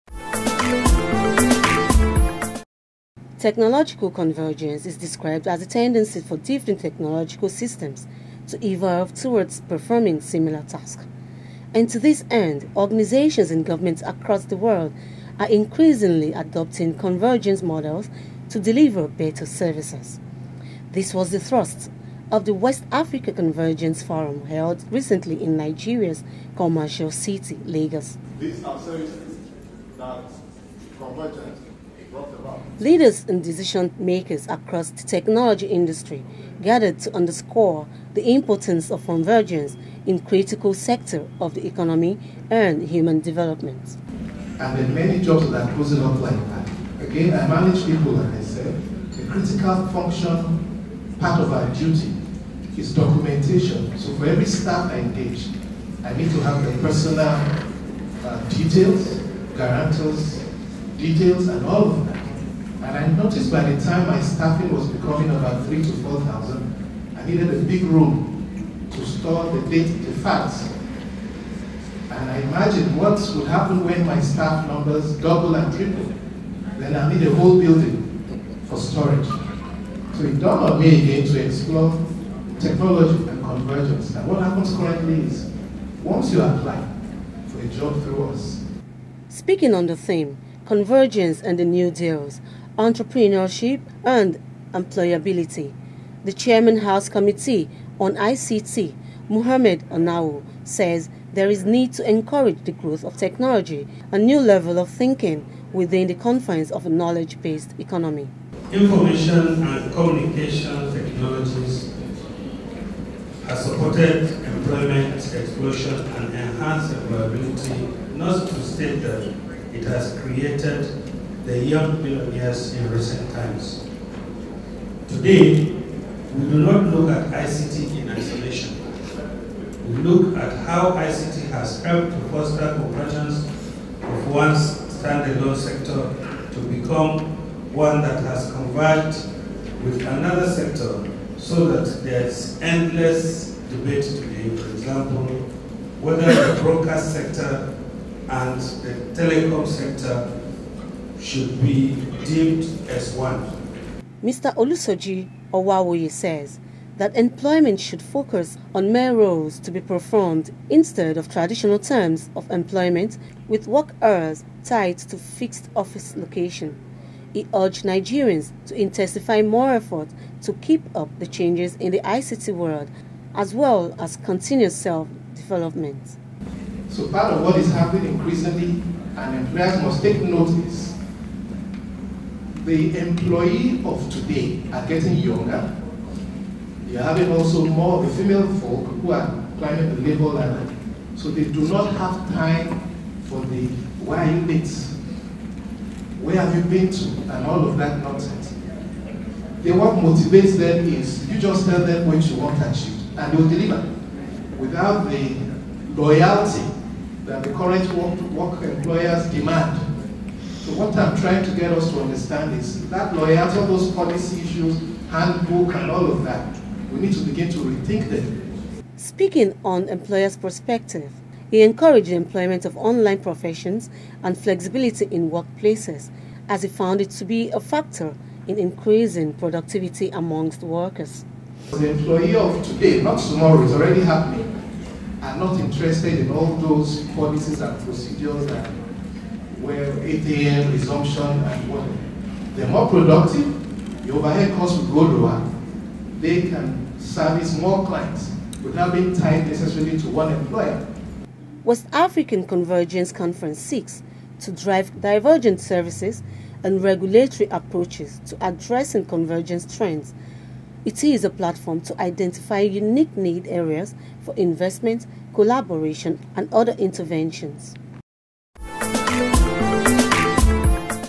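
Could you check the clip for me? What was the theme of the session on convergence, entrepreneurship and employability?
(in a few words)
Convergence and the New Deals.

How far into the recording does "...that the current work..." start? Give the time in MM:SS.
03:27.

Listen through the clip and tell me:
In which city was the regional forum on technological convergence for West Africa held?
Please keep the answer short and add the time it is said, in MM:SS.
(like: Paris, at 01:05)
Lagos, at 00:27.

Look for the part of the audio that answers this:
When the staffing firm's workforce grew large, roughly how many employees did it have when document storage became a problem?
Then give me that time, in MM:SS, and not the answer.
01:05.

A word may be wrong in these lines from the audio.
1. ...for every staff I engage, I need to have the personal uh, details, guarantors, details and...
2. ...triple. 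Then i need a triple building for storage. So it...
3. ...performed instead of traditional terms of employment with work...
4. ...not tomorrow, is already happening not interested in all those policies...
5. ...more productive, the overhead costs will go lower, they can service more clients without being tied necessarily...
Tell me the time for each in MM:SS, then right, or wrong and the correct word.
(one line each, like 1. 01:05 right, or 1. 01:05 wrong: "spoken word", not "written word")
1. 00:54 right
2. 01:15 wrong: "whole", not "triple"
3. 02:39 right
4. 03:53 right
5. 04:02 right.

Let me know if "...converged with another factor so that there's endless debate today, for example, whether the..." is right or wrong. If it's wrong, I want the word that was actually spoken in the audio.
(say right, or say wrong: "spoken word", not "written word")
wrong: "sector", not "factor".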